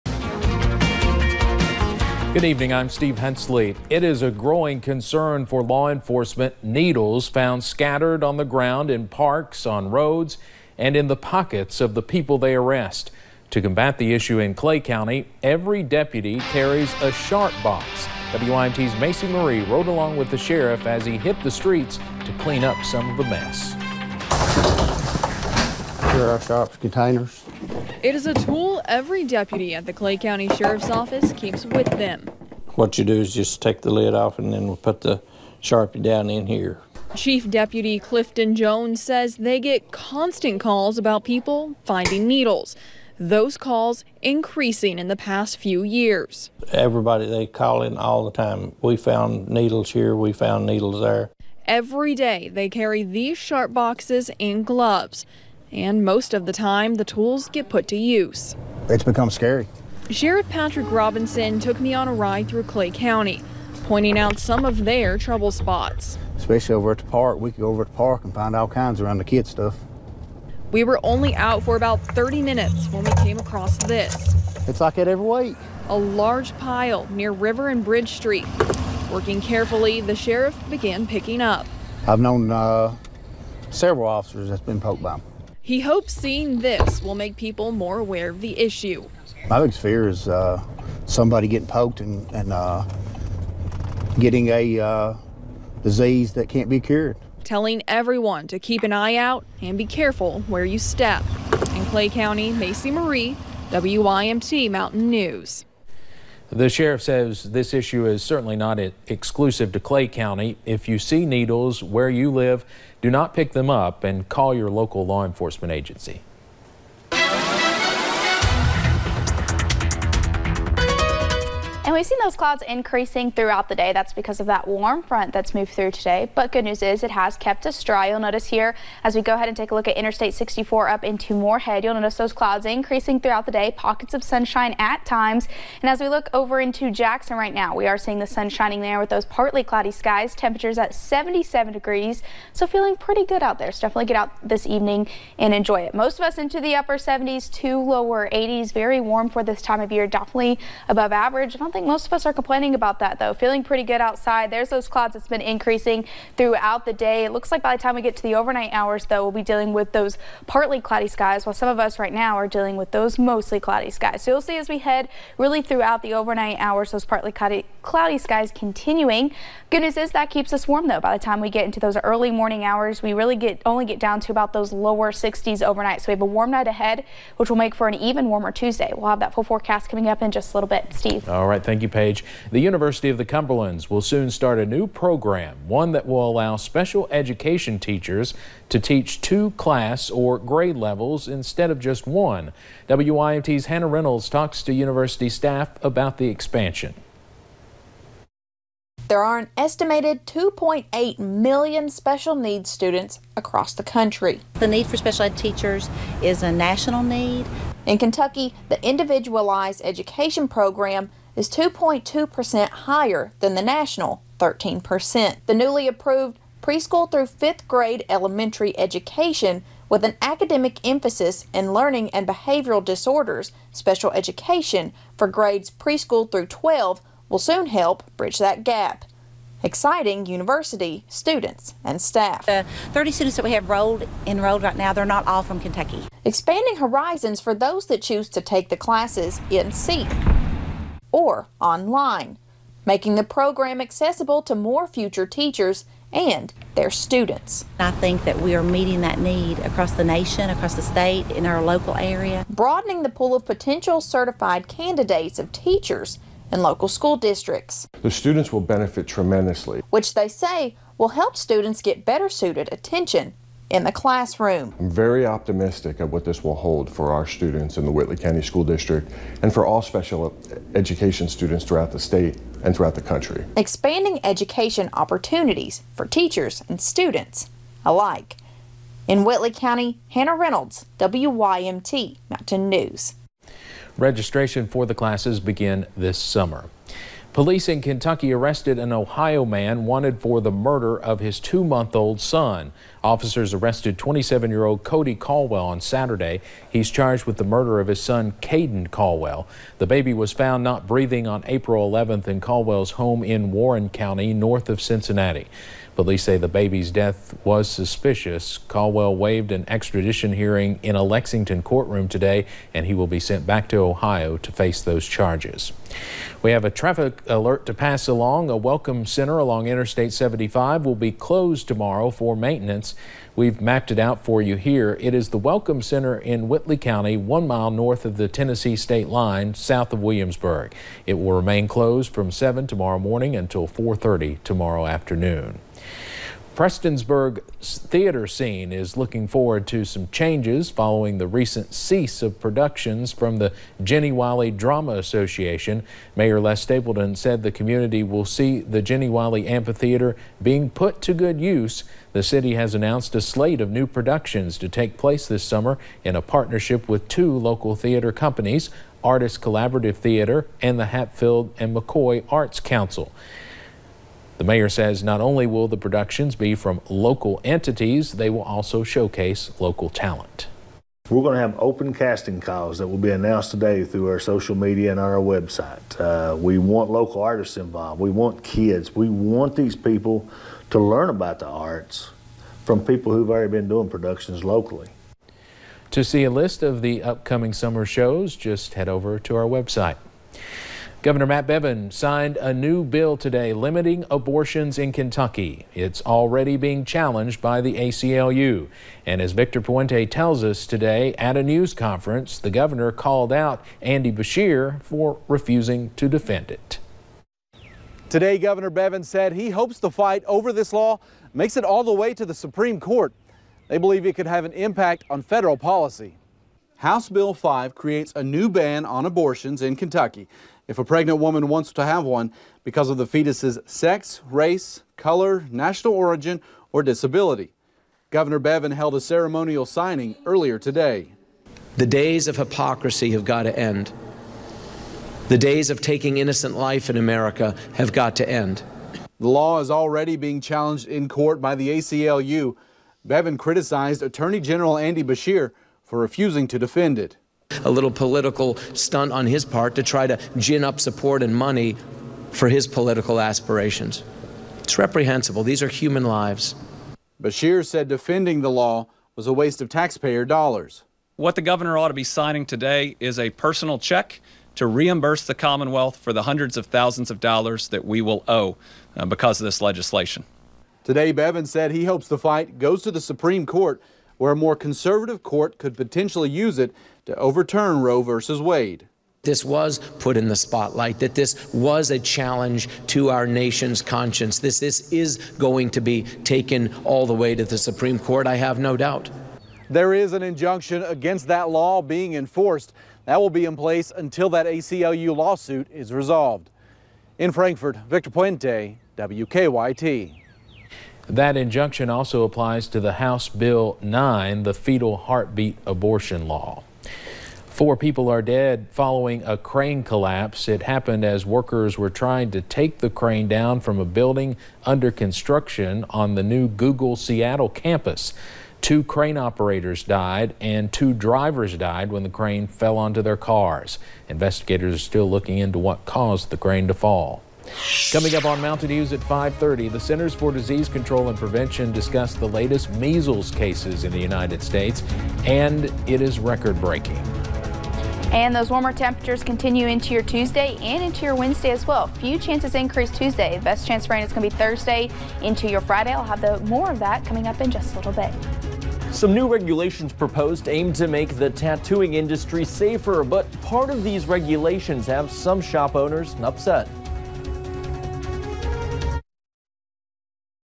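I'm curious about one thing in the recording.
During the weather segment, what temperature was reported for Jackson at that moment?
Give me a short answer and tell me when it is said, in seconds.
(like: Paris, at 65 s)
77 degrees, at 140 s.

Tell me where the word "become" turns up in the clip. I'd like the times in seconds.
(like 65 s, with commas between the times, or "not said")
59 s.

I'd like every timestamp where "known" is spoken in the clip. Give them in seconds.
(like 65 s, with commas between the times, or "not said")
82 s.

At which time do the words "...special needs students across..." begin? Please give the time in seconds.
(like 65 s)
201 s.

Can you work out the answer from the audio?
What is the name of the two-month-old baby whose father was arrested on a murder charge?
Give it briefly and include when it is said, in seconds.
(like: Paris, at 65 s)
Caden Caldwell, at 298 s.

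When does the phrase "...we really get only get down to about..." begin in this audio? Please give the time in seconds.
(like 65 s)
173 s.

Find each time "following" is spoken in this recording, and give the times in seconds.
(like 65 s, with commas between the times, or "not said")
340 s, 508 s.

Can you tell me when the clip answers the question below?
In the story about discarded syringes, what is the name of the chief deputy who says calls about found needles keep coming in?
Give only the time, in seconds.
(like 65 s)
37 s.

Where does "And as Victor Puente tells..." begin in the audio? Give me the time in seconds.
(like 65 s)
399 s.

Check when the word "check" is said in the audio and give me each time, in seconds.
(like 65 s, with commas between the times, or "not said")
463 s.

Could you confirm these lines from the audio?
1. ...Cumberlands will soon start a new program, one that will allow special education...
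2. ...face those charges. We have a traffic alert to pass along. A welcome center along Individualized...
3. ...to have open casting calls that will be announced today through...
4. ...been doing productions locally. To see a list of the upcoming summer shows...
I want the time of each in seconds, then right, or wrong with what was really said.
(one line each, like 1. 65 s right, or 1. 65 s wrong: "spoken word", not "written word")
1. 183 s right
2. 314 s wrong: "Interstate", not "Individualized"
3. 371 s right
4. 383 s right.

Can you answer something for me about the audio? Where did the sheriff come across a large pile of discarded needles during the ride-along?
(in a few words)
River and Bridge Street.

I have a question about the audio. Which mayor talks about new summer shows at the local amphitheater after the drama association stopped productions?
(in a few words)
Les Stapleton.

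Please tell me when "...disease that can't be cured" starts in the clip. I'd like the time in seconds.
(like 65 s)
95 s.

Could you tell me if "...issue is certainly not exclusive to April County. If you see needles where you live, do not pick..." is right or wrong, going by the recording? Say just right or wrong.
wrong.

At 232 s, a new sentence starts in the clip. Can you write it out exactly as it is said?
The 30 students that we have enrolled, enrolled right now, they're not all from Kentucky.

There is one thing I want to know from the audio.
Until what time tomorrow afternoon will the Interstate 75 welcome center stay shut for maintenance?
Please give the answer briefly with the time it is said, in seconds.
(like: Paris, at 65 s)
4:30, at 333 s.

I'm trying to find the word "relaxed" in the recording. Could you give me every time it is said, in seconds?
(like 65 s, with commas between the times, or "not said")
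not said.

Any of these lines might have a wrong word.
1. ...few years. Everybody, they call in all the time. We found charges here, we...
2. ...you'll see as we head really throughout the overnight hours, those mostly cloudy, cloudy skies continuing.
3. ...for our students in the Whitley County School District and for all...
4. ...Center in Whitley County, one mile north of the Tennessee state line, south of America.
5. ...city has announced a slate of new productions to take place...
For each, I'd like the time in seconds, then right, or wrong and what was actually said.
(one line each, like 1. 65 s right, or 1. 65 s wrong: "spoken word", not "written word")
1. 45 s wrong: "needles", not "charges"
2. 164 s wrong: "partly", not "mostly"
3. 266 s right
4. 325 s wrong: "Williamsburg", not "America"
5. 352 s right.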